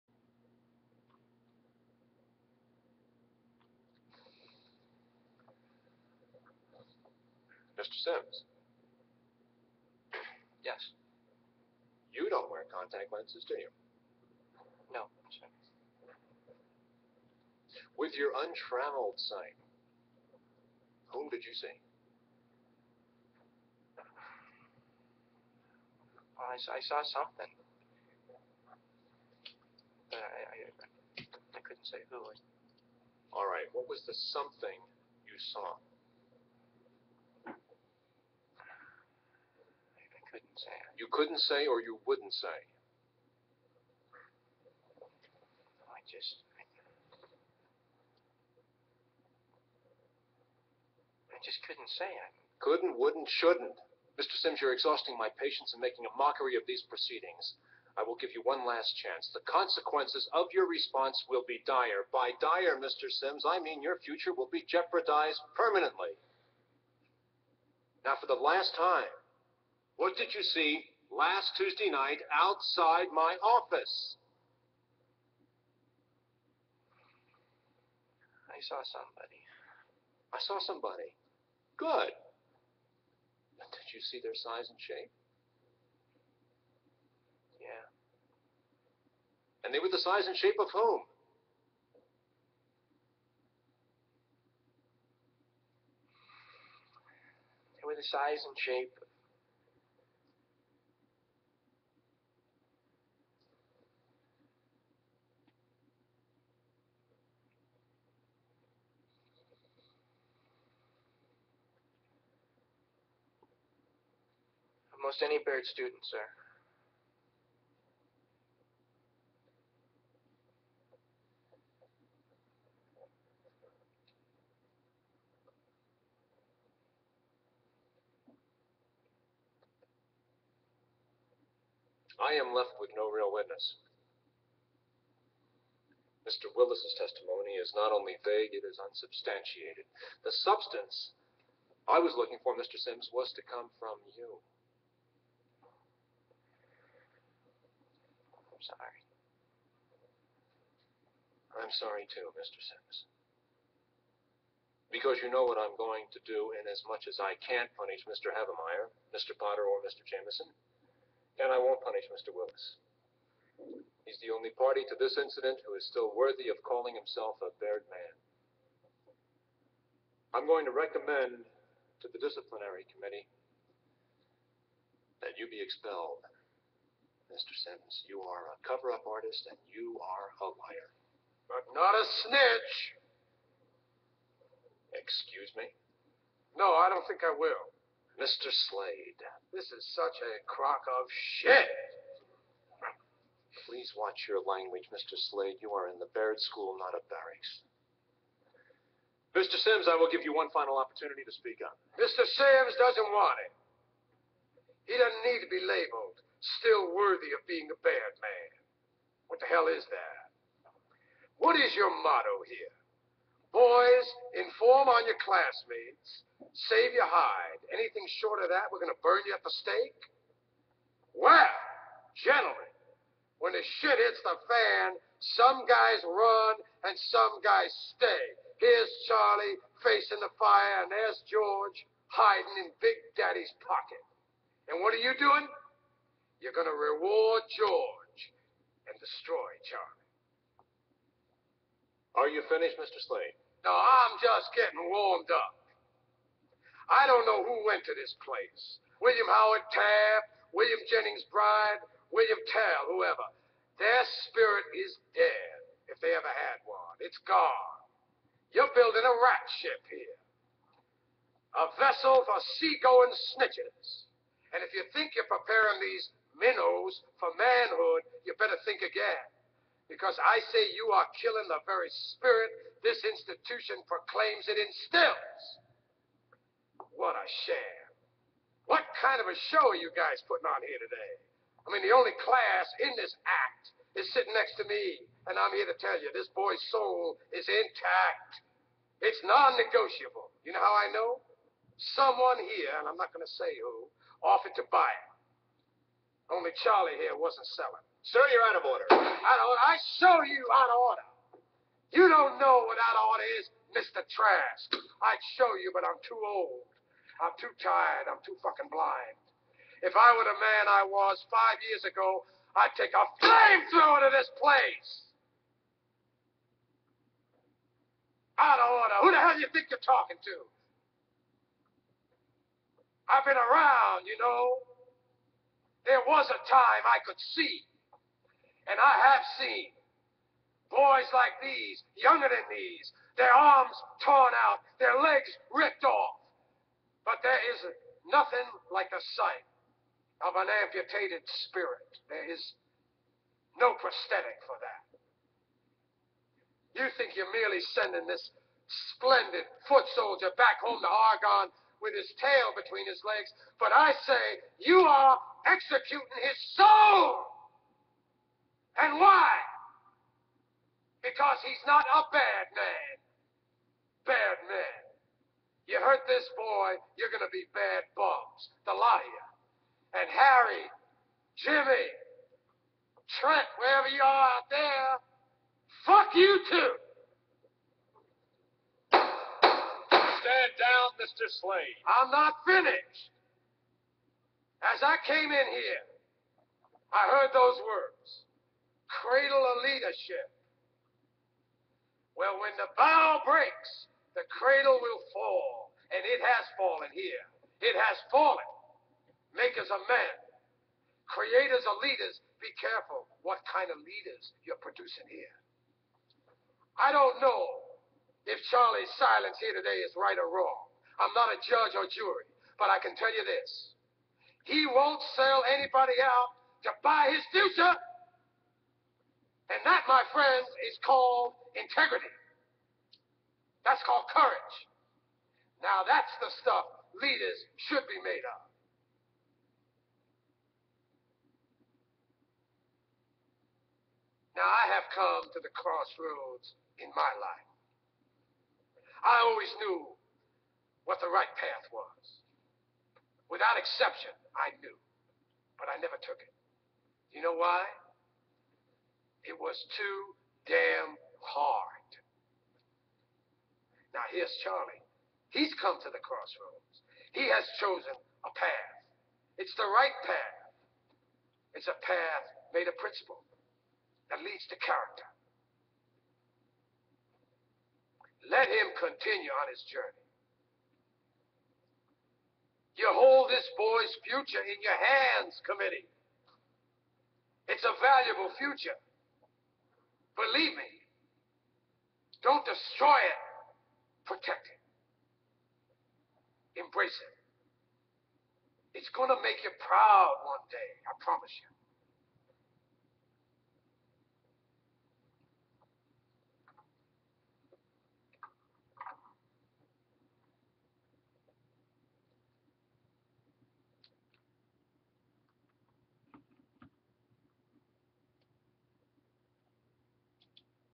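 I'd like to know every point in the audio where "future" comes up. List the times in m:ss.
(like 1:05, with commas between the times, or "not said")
1:04, 6:57, 7:54, 7:58.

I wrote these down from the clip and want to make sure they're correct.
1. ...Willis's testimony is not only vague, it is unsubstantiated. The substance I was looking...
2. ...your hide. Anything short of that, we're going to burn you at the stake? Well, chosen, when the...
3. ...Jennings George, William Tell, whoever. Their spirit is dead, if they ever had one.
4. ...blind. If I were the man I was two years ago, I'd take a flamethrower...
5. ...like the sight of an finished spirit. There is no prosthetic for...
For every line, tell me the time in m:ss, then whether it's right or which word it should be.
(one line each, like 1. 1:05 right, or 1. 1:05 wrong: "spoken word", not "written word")
1. 2:16 right
2. 3:36 wrong: "gentlemen", not "chosen"
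3. 4:10 wrong: "Bryan", not "George"
4. 5:08 wrong: "five", not "two"
5. 5:38 wrong: "amputated", not "finished".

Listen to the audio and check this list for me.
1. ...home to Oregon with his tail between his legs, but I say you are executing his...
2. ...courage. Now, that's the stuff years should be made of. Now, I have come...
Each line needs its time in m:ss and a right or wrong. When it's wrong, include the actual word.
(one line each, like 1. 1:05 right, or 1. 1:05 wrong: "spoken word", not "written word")
1. 5:50 right
2. 7:04 wrong: "leaders", not "years".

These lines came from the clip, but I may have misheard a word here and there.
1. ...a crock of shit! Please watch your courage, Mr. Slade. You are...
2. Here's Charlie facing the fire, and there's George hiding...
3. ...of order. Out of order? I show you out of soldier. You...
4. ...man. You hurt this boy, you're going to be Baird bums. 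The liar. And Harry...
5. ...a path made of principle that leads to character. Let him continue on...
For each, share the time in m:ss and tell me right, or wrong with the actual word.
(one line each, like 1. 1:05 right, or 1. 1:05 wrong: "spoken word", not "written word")
1. 3:10 wrong: "language", not "courage"
2. 3:48 right
3. 4:58 wrong: "order", not "soldier"
4. 6:04 right
5. 7:41 right.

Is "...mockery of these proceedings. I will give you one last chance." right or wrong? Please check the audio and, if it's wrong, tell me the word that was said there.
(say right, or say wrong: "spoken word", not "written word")
right.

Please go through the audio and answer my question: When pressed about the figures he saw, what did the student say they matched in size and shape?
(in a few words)
most any Baird student.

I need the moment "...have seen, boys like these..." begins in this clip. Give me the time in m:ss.
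5:29.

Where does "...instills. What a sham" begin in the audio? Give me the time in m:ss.
4:34.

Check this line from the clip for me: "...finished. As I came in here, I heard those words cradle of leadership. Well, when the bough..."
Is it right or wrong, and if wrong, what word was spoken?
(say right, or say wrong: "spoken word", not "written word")
right.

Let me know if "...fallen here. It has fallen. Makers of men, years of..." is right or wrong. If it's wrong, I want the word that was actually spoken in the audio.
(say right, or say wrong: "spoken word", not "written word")
wrong: "creators", not "years".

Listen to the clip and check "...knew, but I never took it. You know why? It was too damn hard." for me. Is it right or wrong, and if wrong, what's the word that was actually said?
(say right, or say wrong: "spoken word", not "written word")
right.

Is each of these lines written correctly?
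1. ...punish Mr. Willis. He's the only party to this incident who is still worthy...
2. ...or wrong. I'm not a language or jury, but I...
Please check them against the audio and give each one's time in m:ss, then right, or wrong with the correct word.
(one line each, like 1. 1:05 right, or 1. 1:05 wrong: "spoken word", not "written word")
1. 2:41 right
2. 6:50 wrong: "judge", not "language".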